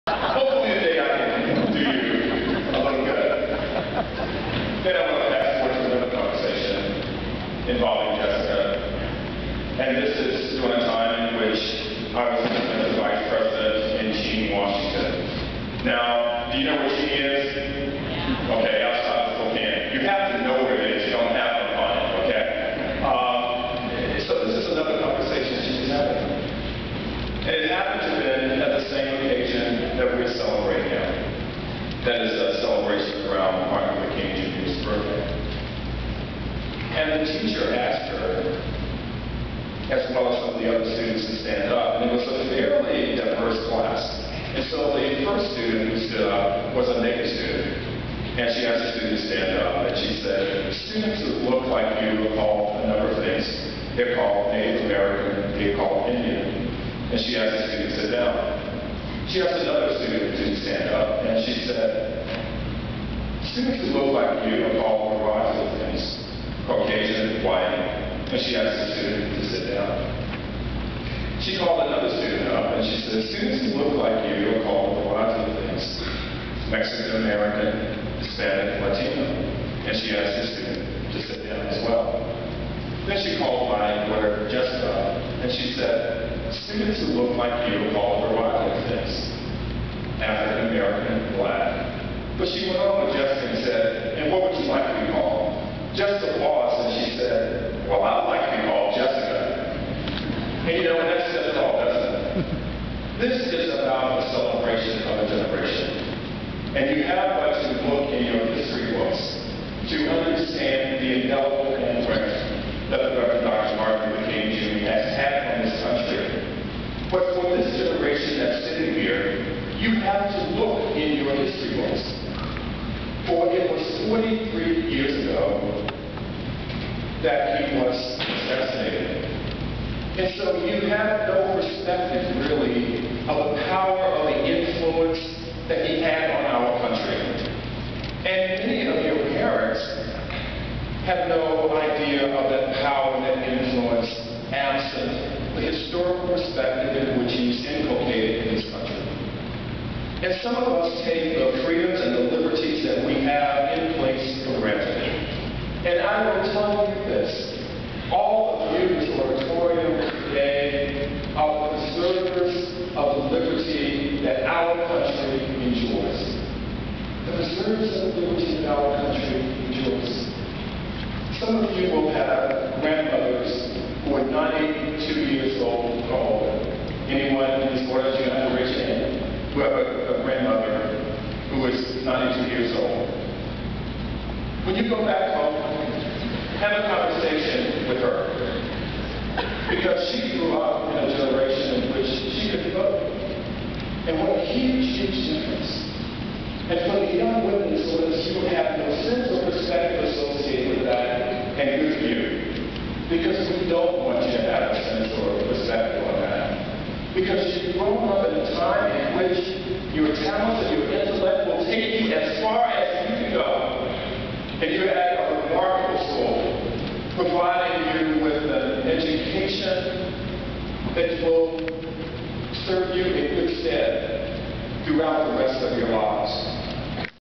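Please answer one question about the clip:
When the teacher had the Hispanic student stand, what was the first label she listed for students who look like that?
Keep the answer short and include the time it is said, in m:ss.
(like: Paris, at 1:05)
Mexican American, at 1:16.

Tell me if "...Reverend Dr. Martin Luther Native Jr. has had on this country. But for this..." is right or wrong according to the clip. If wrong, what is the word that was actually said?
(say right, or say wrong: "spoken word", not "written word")
wrong: "King", not "Native".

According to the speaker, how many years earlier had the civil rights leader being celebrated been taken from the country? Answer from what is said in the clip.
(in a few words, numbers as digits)
43.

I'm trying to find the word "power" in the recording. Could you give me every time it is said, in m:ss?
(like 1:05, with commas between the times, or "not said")
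2:13, 2:22.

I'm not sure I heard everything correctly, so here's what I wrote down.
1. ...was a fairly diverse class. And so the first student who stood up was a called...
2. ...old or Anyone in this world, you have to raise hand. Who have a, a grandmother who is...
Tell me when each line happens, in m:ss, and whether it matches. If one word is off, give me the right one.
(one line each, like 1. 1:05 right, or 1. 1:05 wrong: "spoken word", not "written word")
1. 0:42 wrong: "naked", not "called"
2. 2:55 right.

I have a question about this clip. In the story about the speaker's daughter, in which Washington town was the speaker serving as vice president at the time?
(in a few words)
Cheney.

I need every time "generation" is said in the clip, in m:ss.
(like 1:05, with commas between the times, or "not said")
1:45, 1:57, 3:11.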